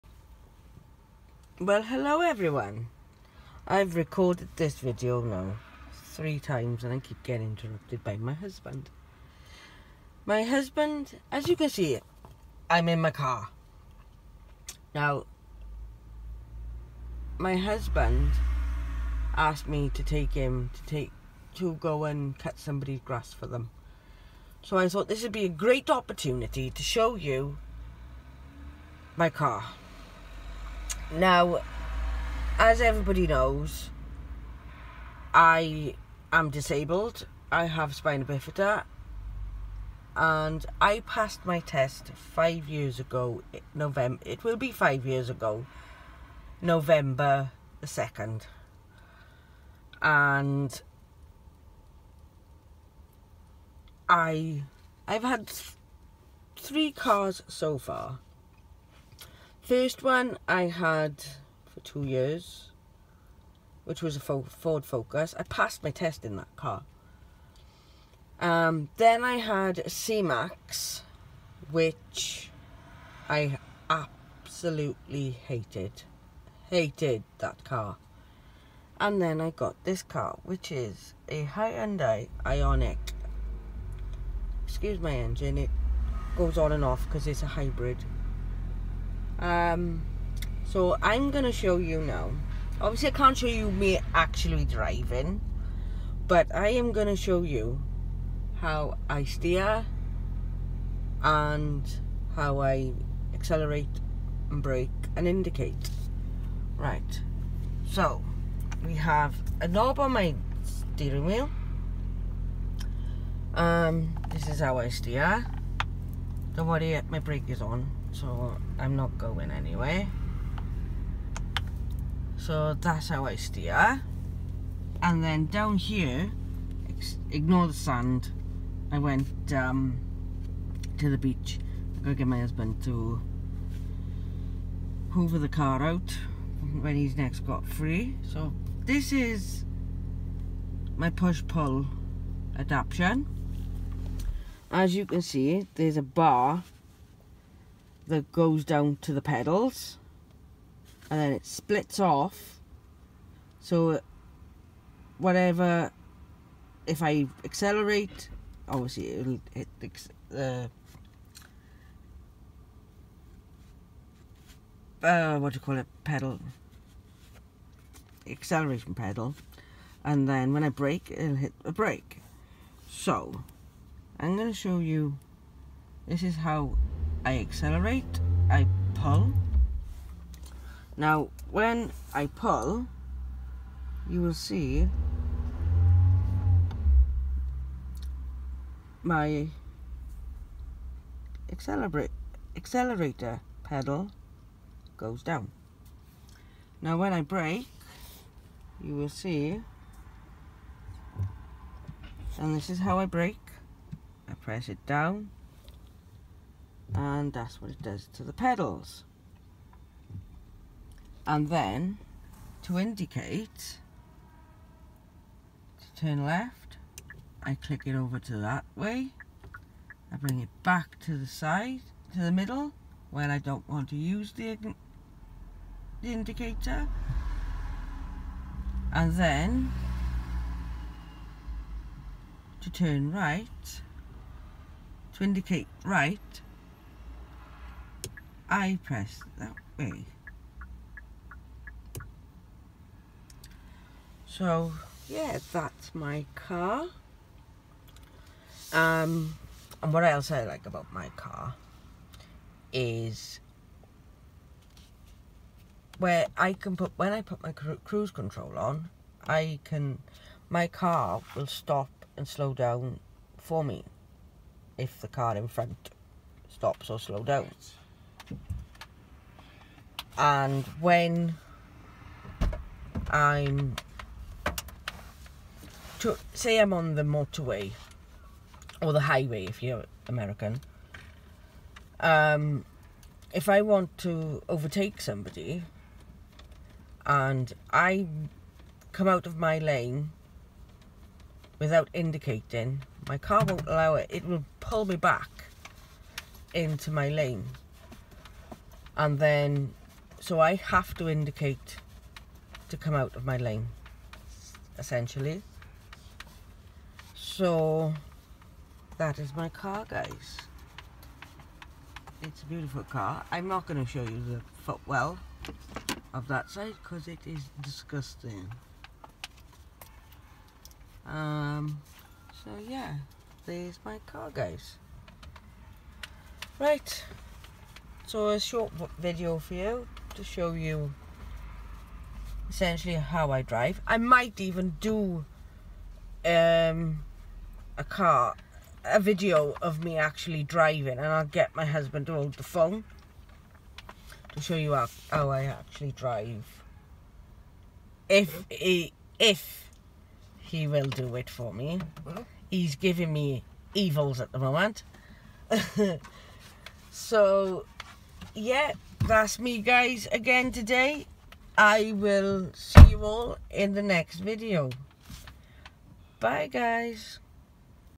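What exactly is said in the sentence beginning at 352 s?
He's giving me evils at the moment.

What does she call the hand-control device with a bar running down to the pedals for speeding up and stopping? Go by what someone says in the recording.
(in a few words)
push-pull adaptation.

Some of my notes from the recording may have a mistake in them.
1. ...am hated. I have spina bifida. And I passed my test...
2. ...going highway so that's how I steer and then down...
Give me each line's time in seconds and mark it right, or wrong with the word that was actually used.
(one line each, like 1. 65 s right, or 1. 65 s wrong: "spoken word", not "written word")
1. 36 s wrong: "disabled", not "hated"
2. 119 s wrong: "anyway", not "highway".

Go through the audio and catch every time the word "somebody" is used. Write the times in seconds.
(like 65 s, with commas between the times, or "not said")
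22 s, 284 s.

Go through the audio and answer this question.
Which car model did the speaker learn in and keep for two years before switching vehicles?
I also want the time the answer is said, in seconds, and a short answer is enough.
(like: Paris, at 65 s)
Ford Focus, at 64 s.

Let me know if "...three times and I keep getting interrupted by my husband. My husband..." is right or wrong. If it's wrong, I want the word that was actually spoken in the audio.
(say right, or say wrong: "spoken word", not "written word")
right.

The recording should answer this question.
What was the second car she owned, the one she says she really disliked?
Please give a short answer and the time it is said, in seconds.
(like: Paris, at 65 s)
C-Max, at 69 s.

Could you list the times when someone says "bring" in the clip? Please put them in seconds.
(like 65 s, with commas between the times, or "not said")
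220 s.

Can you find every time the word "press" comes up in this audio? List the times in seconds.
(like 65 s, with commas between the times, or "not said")
204 s, 238 s.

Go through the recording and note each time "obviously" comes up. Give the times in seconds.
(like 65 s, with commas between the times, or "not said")
92 s, 158 s.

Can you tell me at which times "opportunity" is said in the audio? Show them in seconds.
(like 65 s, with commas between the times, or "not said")
25 s.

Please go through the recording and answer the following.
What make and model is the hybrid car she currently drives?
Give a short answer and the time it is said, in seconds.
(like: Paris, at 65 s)
Hyundai Ioniq, at 81 s.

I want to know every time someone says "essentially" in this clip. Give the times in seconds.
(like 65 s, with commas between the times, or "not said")
304 s, 332 s.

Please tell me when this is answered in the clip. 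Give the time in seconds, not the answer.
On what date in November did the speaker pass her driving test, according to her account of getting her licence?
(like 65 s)
46 s.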